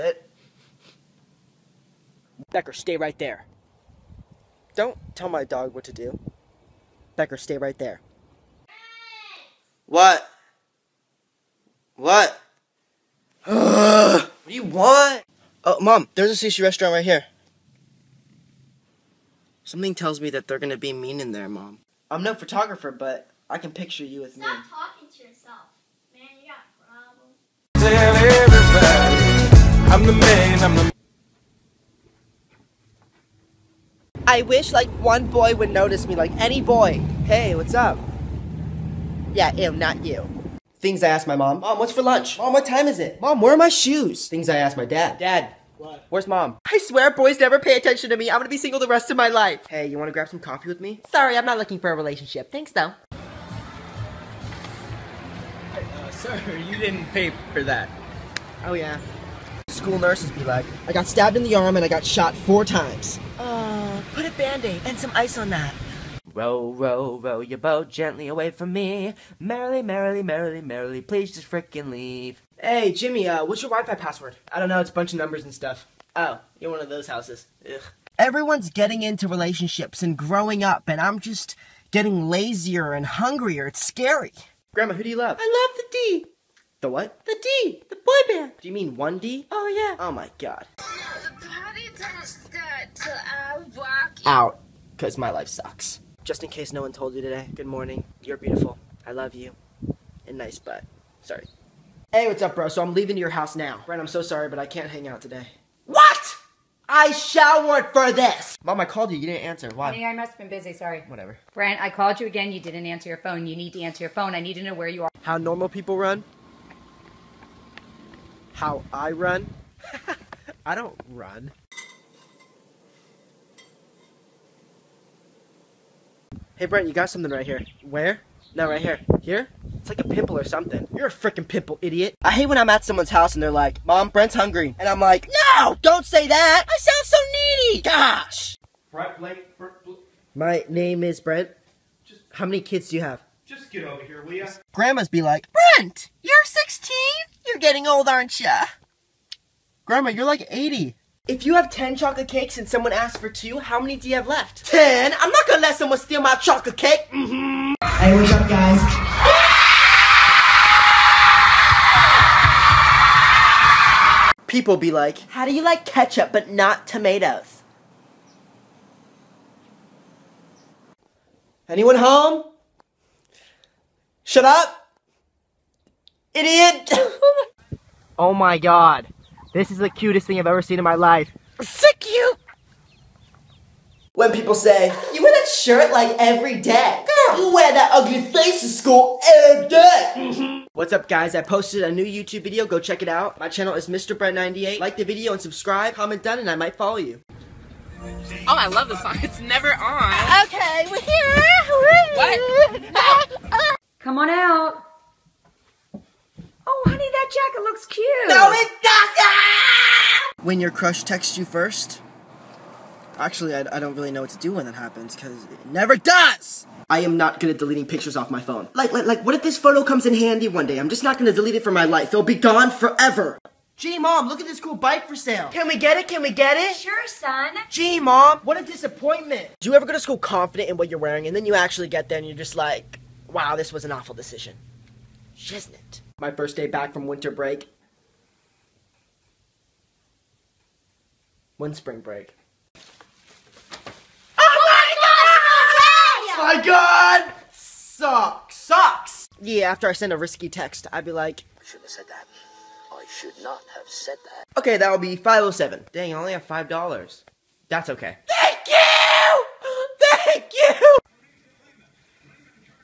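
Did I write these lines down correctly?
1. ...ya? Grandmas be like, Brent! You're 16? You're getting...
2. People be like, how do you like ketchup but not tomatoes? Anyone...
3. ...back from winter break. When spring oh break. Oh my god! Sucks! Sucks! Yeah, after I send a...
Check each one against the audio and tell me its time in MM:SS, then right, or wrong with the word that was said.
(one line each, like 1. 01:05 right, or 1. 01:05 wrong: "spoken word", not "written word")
1. 02:24 right
2. 02:44 right
3. 03:56 right.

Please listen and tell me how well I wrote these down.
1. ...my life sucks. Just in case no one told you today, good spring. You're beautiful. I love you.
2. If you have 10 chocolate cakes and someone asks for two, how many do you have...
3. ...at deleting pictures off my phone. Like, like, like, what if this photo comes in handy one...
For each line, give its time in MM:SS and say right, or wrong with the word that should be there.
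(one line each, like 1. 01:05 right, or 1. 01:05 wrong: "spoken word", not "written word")
1. 01:35 wrong: "morning", not "spring"
2. 02:31 right
3. 03:37 right.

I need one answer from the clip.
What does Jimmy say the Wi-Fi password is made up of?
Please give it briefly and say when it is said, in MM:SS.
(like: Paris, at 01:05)
a bunch of numbers, at 01:14.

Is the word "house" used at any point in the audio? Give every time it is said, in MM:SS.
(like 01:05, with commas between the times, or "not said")
01:17, 01:43, 02:13.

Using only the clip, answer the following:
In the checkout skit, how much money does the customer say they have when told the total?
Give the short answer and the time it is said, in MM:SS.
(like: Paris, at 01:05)
$5, at 04:16.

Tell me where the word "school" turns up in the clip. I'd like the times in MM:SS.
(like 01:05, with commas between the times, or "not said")
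00:59, 03:08, 03:49.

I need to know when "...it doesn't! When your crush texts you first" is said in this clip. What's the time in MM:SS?
03:28.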